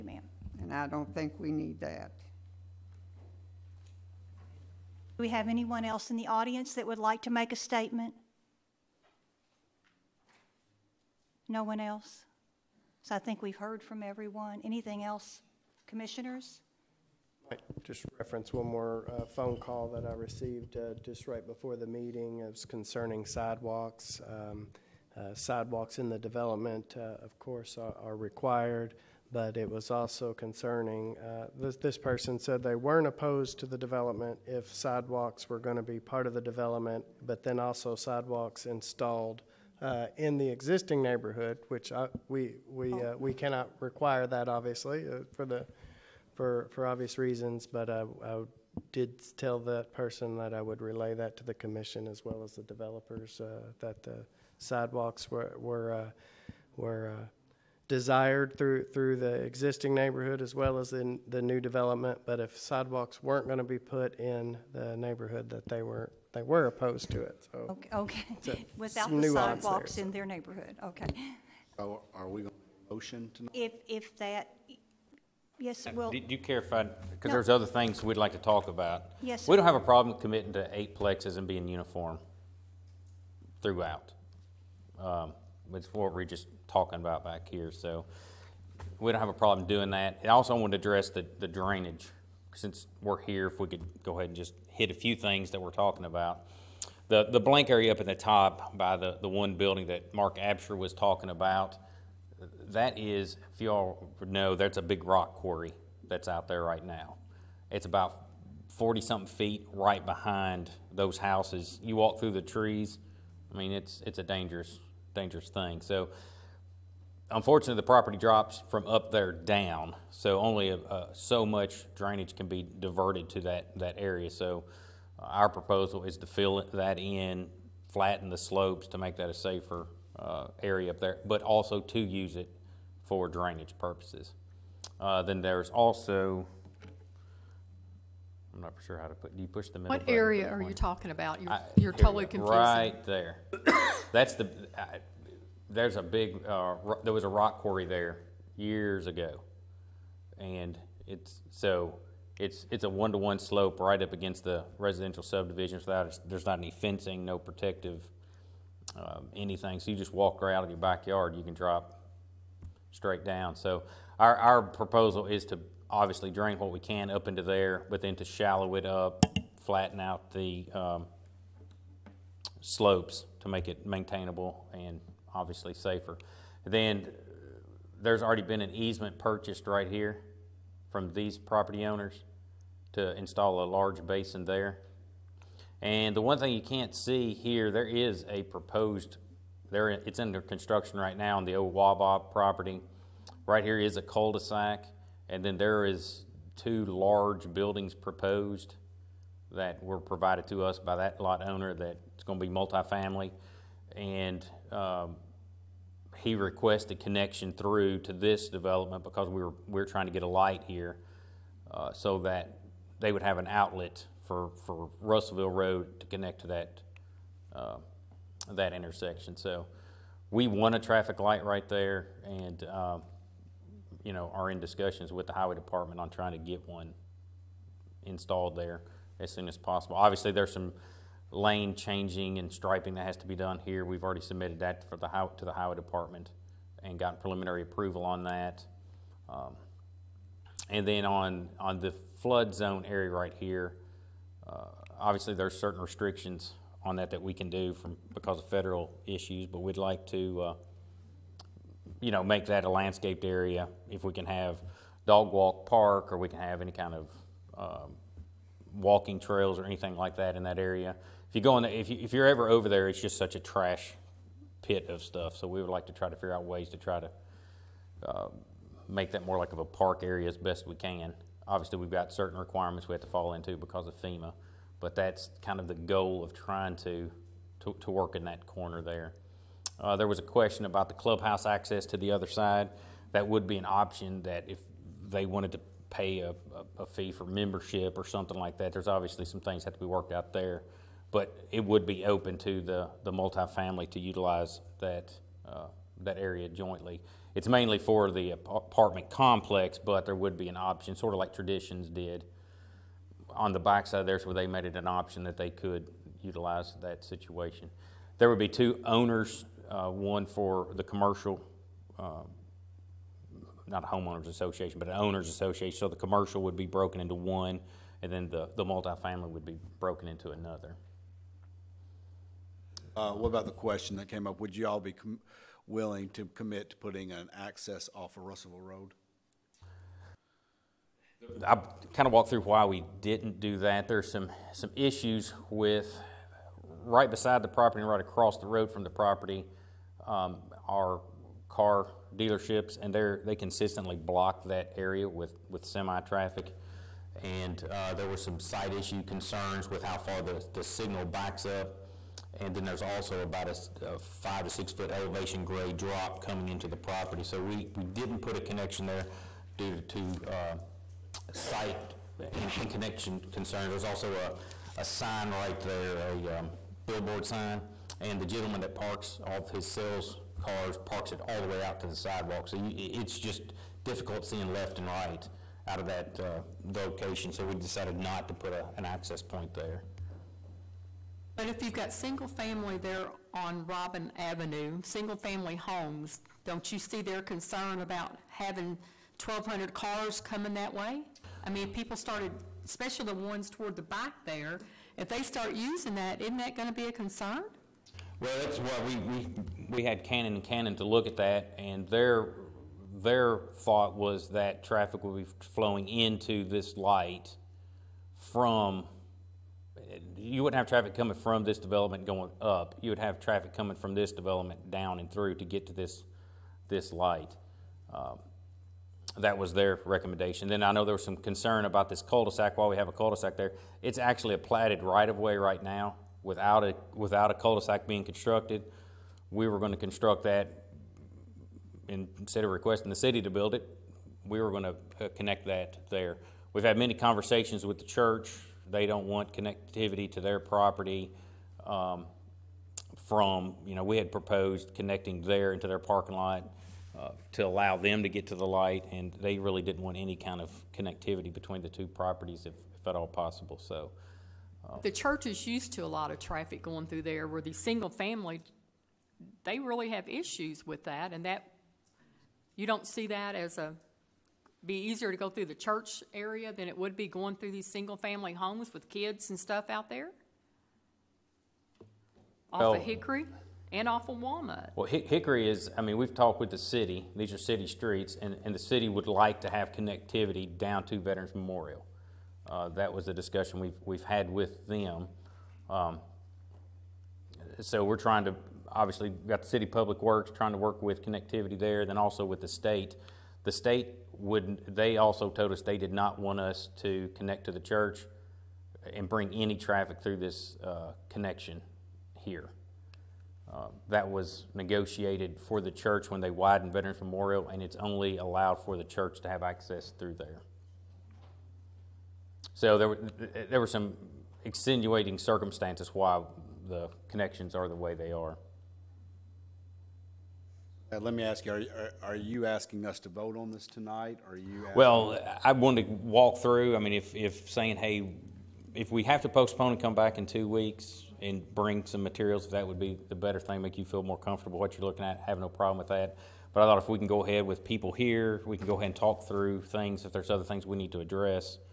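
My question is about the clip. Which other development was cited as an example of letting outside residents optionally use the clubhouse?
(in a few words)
Traditions.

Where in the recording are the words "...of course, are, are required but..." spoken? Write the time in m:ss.
0:27.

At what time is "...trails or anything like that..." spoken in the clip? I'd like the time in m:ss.
4:19.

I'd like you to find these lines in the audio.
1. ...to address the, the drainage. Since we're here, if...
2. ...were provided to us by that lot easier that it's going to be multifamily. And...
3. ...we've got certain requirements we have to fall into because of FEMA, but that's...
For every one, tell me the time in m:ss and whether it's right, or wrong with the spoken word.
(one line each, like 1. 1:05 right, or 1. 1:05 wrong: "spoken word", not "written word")
1. 1:30 right
2. 3:19 wrong: "owner", not "easier"
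3. 4:31 right.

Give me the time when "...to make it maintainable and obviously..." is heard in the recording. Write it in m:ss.
2:53.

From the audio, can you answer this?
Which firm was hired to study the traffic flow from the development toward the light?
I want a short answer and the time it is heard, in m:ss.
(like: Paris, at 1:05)
Cannon and Cannon, at 6:40.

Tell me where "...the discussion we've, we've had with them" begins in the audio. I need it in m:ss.
8:03.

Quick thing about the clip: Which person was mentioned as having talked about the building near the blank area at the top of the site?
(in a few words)
Mark Absher.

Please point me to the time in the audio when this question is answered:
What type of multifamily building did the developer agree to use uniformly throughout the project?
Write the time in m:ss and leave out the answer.
1:20.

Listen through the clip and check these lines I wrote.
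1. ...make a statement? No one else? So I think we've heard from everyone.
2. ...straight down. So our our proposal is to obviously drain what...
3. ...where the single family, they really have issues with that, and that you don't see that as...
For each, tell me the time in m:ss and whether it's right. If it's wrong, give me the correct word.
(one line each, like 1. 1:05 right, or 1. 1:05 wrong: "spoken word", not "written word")
1. 0:07 right
2. 2:42 right
3. 7:37 right.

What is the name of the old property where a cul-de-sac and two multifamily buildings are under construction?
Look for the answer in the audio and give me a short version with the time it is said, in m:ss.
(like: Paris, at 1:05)
Wabob, at 3:11.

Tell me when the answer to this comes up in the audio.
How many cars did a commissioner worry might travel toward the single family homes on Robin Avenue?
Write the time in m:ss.
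6:29.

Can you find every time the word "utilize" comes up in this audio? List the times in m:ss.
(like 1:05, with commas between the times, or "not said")
4:53, 5:06.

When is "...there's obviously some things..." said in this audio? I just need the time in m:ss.
4:48.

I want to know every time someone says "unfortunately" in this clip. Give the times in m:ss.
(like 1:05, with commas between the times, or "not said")
1:57.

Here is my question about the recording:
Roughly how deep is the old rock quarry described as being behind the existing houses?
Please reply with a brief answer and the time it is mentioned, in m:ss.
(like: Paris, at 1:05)
40 something feet, at 1:48.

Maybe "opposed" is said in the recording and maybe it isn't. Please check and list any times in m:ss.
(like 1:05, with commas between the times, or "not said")
0:33, 1:06.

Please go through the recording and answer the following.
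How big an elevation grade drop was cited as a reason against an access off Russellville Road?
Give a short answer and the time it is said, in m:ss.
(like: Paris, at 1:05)
5 to 6 feet, at 5:54.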